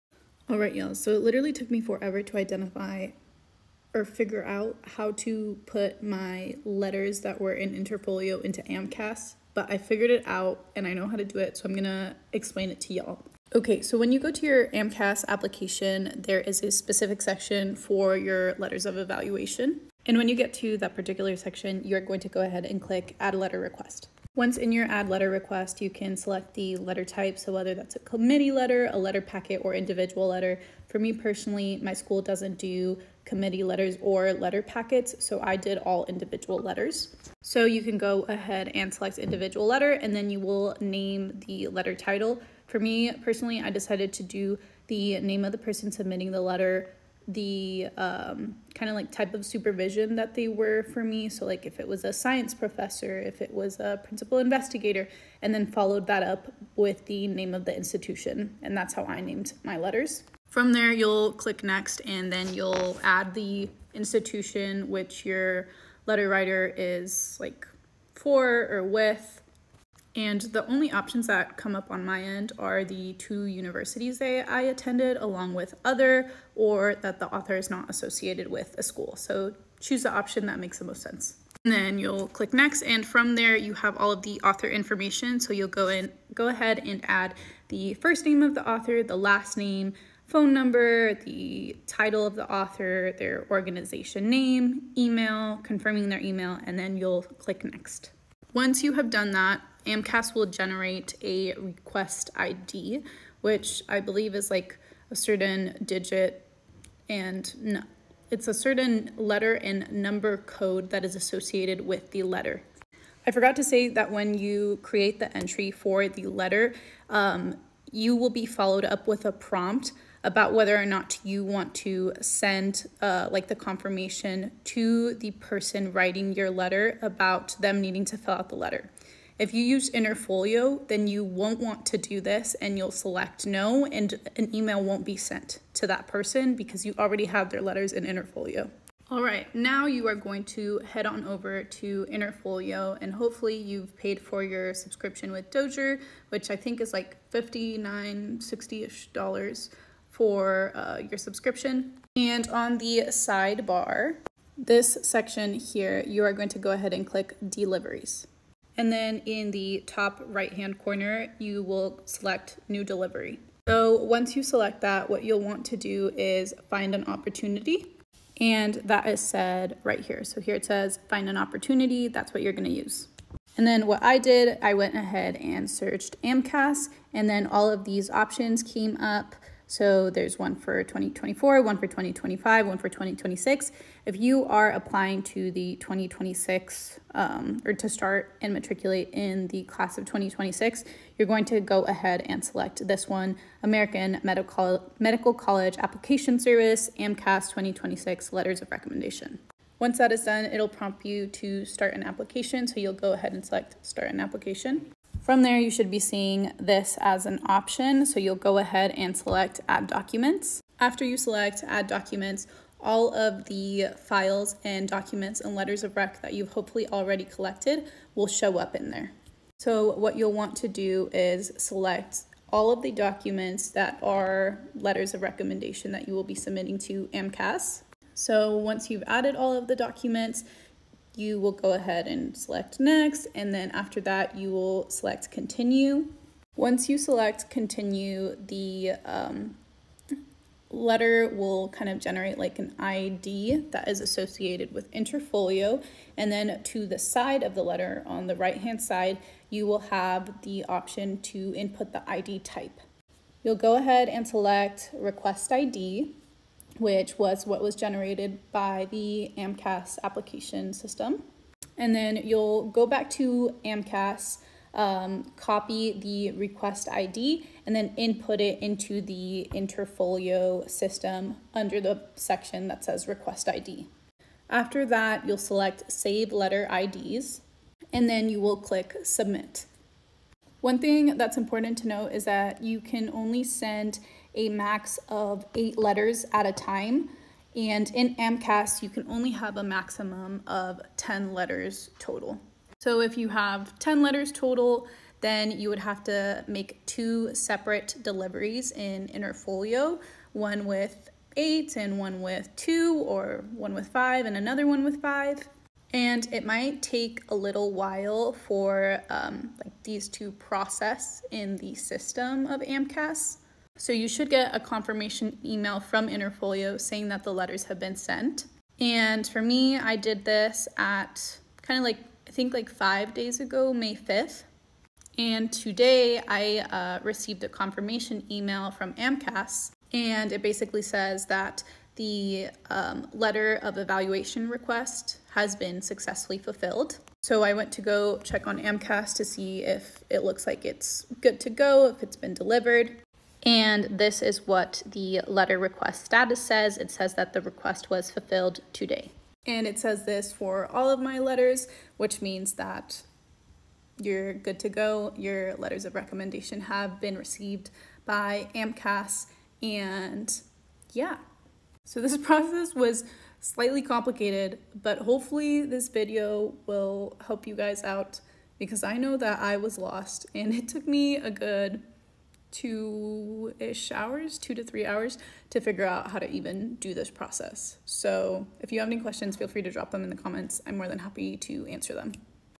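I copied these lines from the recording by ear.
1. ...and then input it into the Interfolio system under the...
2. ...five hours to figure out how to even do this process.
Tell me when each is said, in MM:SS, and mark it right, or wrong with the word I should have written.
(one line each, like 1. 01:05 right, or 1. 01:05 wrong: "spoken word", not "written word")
1. 04:27 right
2. 06:14 wrong: "three", not "five".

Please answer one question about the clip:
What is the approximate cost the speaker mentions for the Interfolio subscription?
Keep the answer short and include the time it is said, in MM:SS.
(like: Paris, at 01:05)
$59, at 02:27.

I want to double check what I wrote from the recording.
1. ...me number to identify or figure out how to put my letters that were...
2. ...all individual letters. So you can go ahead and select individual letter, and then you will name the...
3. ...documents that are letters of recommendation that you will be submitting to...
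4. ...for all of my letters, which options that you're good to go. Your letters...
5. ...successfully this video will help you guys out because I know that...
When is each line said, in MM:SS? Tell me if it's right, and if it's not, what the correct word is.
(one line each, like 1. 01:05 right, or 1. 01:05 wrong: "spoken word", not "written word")
1. 00:01 wrong: "forever", not "number"
2. 00:35 right
3. 03:42 right
4. 05:50 wrong: "means", not "options"
5. 06:04 wrong: "hopefully", not "successfully".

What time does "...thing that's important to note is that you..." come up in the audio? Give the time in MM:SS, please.
04:40.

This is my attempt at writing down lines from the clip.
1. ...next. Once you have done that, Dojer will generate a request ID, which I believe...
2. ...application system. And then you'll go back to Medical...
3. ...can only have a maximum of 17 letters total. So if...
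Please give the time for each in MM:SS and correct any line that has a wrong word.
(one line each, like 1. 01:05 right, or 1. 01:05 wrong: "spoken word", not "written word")
1. 01:37 wrong: "AMCAS", not "Dojer"
2. 04:20 wrong: "AMCAS", not "Medical"
3. 04:48 wrong: "10", not "17".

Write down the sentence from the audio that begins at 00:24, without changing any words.
Once in your add letter request, you can select the letter type.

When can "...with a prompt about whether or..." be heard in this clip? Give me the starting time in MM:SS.
01:59.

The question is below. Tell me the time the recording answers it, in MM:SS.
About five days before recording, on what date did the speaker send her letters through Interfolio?
05:23.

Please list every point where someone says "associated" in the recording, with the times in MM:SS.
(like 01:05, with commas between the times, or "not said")
01:17, 01:51, 04:03.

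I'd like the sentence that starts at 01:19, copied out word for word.
So choose the option that makes the most sense.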